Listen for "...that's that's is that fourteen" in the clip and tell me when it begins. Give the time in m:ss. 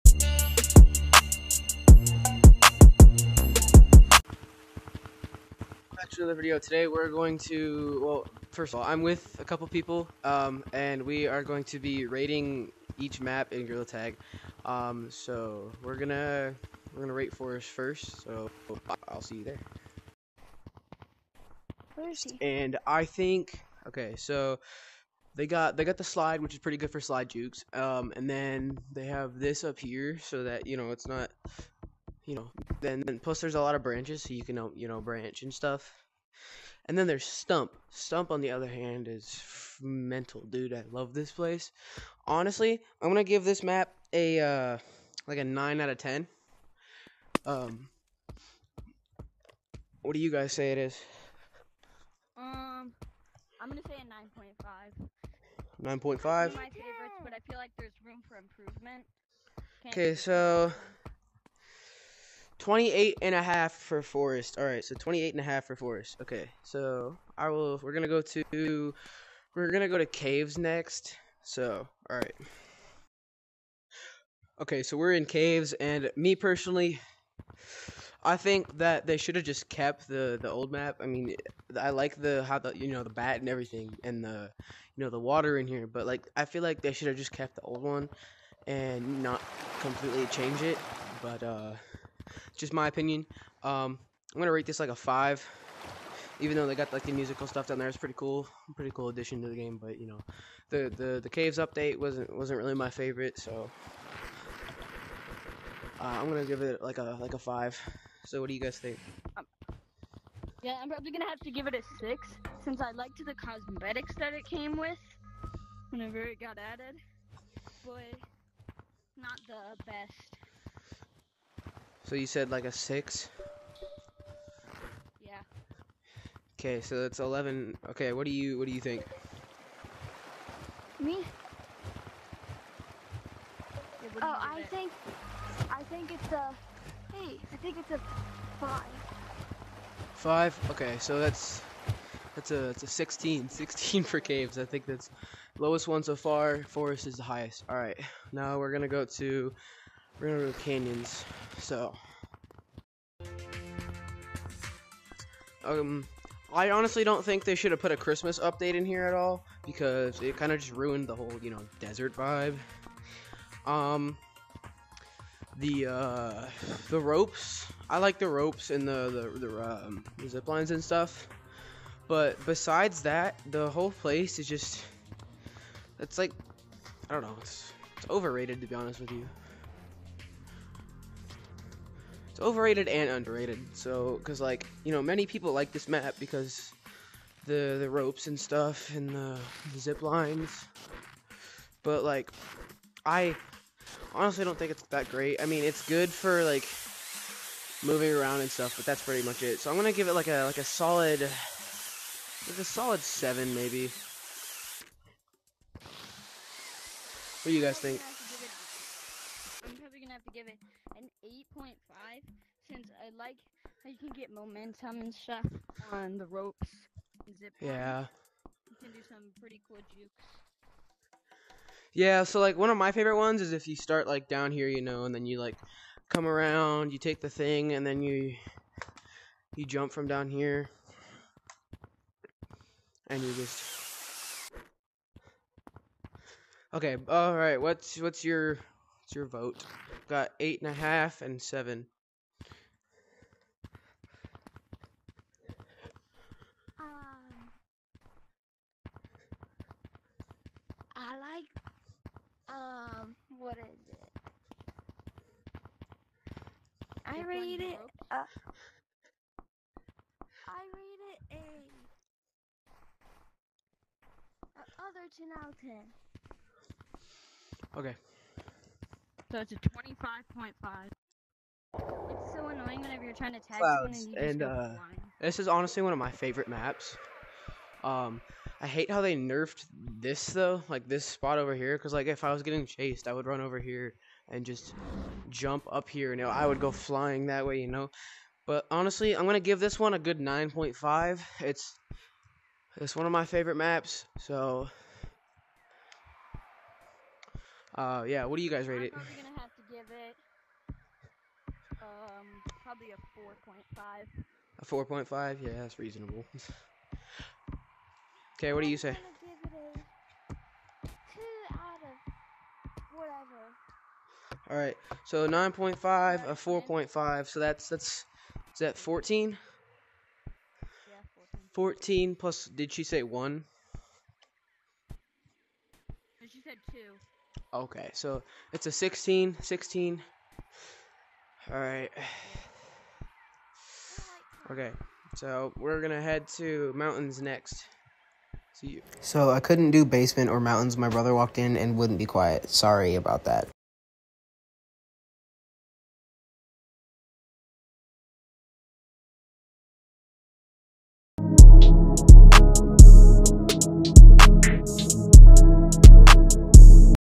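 5:17.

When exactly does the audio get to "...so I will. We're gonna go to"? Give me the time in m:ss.
1:06.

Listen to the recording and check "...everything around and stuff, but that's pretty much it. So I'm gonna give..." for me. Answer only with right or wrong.
wrong.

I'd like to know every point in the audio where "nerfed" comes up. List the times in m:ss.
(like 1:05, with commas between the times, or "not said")
4:39.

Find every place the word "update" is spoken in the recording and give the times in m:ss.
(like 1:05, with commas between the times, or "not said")
1:41, 2:38.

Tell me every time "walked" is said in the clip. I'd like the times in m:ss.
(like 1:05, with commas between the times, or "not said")
5:41.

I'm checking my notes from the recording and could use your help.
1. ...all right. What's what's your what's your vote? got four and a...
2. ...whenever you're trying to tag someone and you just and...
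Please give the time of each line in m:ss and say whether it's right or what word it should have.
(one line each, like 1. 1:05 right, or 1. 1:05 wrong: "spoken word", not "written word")
1. 3:57 wrong: "eight", not "four"
2. 4:32 right.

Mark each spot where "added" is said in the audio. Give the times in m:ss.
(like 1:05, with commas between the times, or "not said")
1:56.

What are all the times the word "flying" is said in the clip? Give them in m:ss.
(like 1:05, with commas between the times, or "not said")
4:46.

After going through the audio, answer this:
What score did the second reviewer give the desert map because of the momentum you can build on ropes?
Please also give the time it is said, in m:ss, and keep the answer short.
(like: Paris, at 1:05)
8.5, at 3:31.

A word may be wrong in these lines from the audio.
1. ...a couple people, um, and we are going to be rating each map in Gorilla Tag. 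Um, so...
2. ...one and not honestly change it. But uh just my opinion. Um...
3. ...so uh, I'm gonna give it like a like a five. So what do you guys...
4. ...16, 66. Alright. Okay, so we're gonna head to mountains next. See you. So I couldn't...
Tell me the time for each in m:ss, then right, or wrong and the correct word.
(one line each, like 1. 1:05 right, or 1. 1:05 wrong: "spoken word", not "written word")
1. 0:09 right
2. 1:27 wrong: "completely", not "honestly"
3. 1:43 right
4. 5:28 wrong: "16", not "66".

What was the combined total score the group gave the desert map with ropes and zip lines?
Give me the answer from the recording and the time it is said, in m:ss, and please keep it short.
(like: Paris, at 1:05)
25.5, at 4:29.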